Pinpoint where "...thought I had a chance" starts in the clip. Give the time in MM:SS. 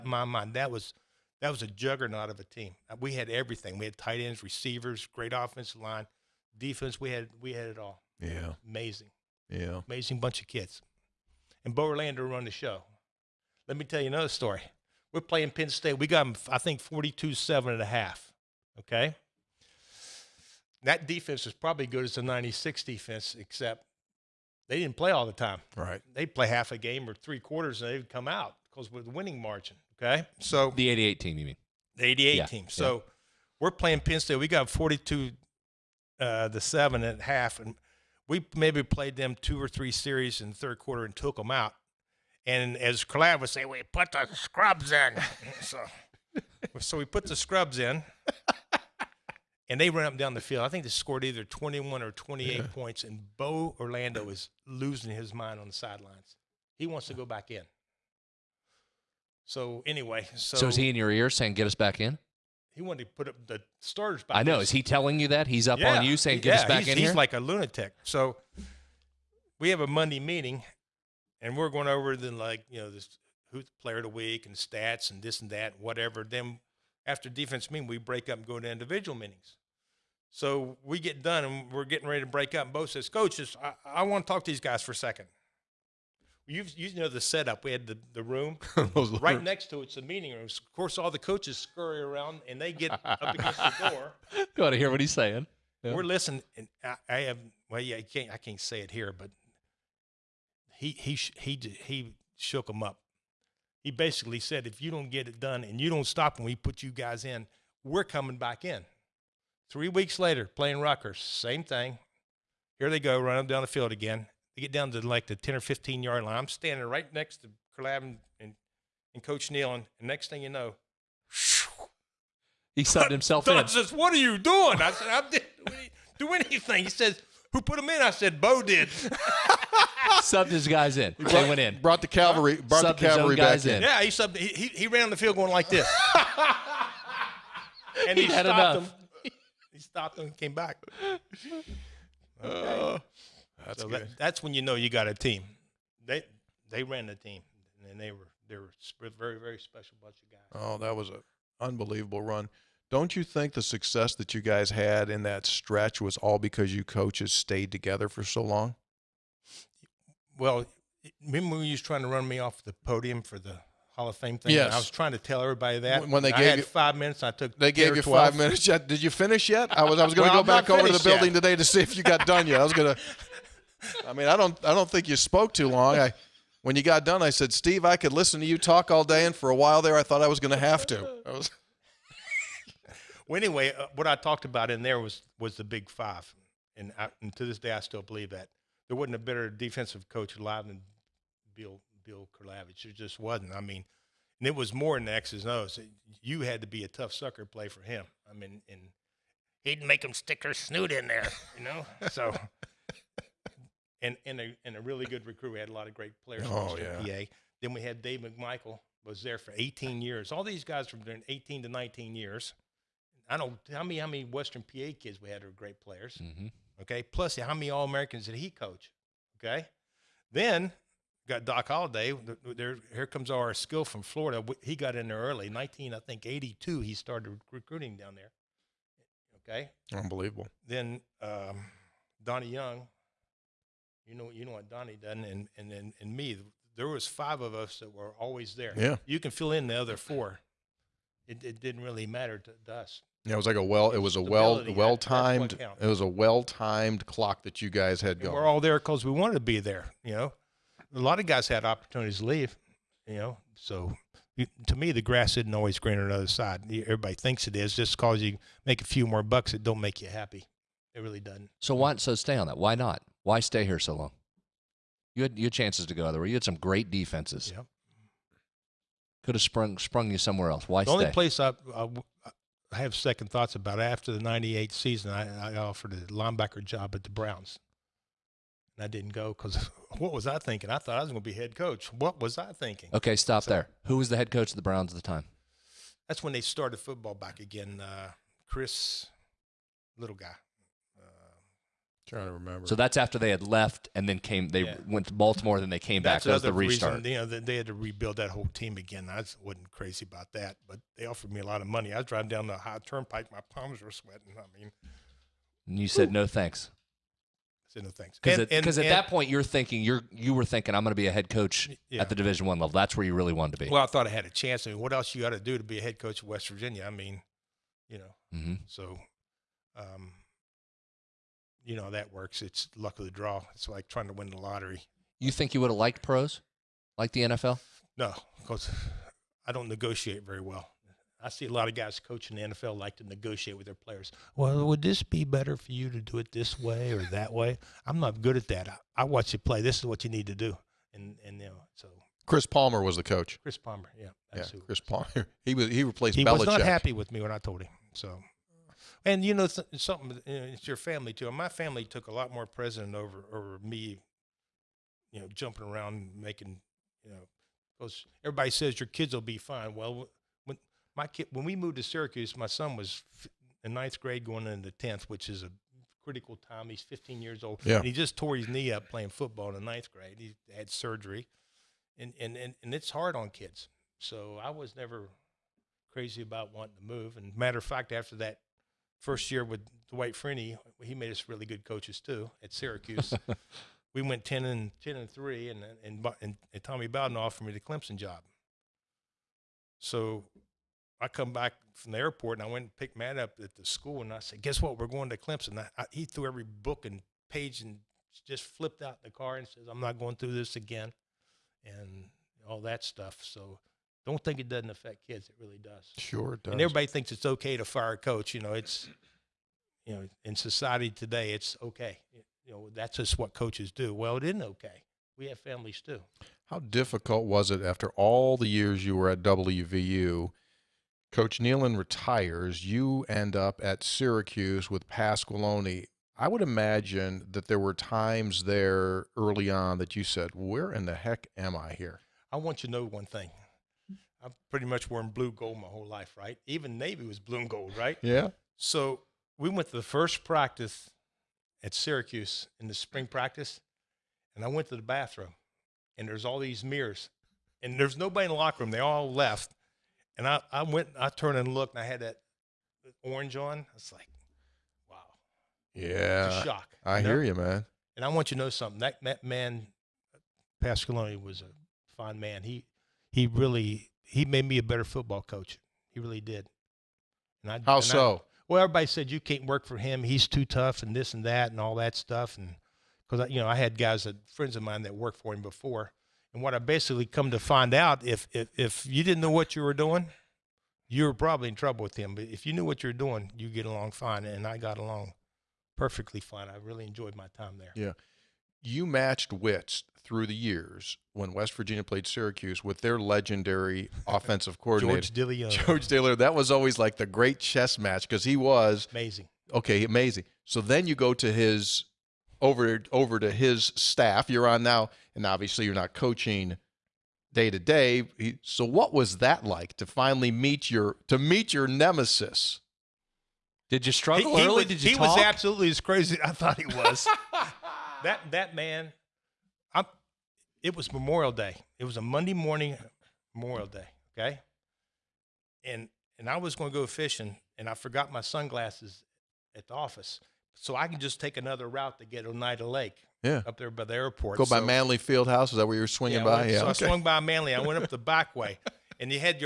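05:13.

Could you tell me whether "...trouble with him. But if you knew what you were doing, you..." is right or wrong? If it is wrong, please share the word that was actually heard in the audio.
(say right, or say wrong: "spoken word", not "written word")
right.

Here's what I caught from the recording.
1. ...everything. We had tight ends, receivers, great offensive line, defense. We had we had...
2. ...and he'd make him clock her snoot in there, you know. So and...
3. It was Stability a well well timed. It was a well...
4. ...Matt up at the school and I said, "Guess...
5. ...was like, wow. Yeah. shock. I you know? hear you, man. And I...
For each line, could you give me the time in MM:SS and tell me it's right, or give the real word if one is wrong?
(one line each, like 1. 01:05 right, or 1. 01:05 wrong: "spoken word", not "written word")
1. 00:03 right
2. 03:18 wrong: "stick", not "clock"
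3. 04:03 right
4. 06:32 right
5. 07:33 right.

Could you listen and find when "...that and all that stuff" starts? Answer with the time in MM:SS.
07:51.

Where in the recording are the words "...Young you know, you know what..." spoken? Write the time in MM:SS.
03:52.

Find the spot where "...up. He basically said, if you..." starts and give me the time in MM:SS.
01:42.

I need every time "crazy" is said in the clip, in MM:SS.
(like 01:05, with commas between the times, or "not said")
04:59, 06:15, 08:35.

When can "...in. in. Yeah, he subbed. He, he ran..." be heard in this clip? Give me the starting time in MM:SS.
02:13.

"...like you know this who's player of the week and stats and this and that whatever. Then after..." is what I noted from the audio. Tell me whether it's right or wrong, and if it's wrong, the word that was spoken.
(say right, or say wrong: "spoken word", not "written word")
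right.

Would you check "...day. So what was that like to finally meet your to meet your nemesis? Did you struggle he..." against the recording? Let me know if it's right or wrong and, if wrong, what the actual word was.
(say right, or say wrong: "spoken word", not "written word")
right.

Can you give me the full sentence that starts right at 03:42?
There, here comes our skill from Florida.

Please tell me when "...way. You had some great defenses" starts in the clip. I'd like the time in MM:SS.
04:26.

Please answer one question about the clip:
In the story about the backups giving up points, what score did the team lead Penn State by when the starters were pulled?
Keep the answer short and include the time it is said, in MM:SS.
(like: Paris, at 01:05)
42-7, at 00:16.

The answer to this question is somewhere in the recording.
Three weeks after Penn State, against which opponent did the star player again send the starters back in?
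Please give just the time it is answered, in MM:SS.
01:50.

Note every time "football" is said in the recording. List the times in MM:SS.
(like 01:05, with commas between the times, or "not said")
04:46, 06:09, 07:44.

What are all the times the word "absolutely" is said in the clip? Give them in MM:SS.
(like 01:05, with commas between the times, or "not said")
08:35.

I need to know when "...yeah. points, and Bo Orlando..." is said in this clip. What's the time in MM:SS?
00:52.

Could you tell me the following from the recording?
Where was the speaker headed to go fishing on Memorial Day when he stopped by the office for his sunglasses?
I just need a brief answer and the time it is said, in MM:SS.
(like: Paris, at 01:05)
Oneida Lake, at 08:52.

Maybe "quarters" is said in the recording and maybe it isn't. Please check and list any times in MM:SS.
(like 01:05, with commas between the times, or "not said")
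00:27, 00:40.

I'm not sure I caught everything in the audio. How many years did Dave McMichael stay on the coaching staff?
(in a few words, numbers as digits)
18.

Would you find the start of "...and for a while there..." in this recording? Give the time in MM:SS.
02:59.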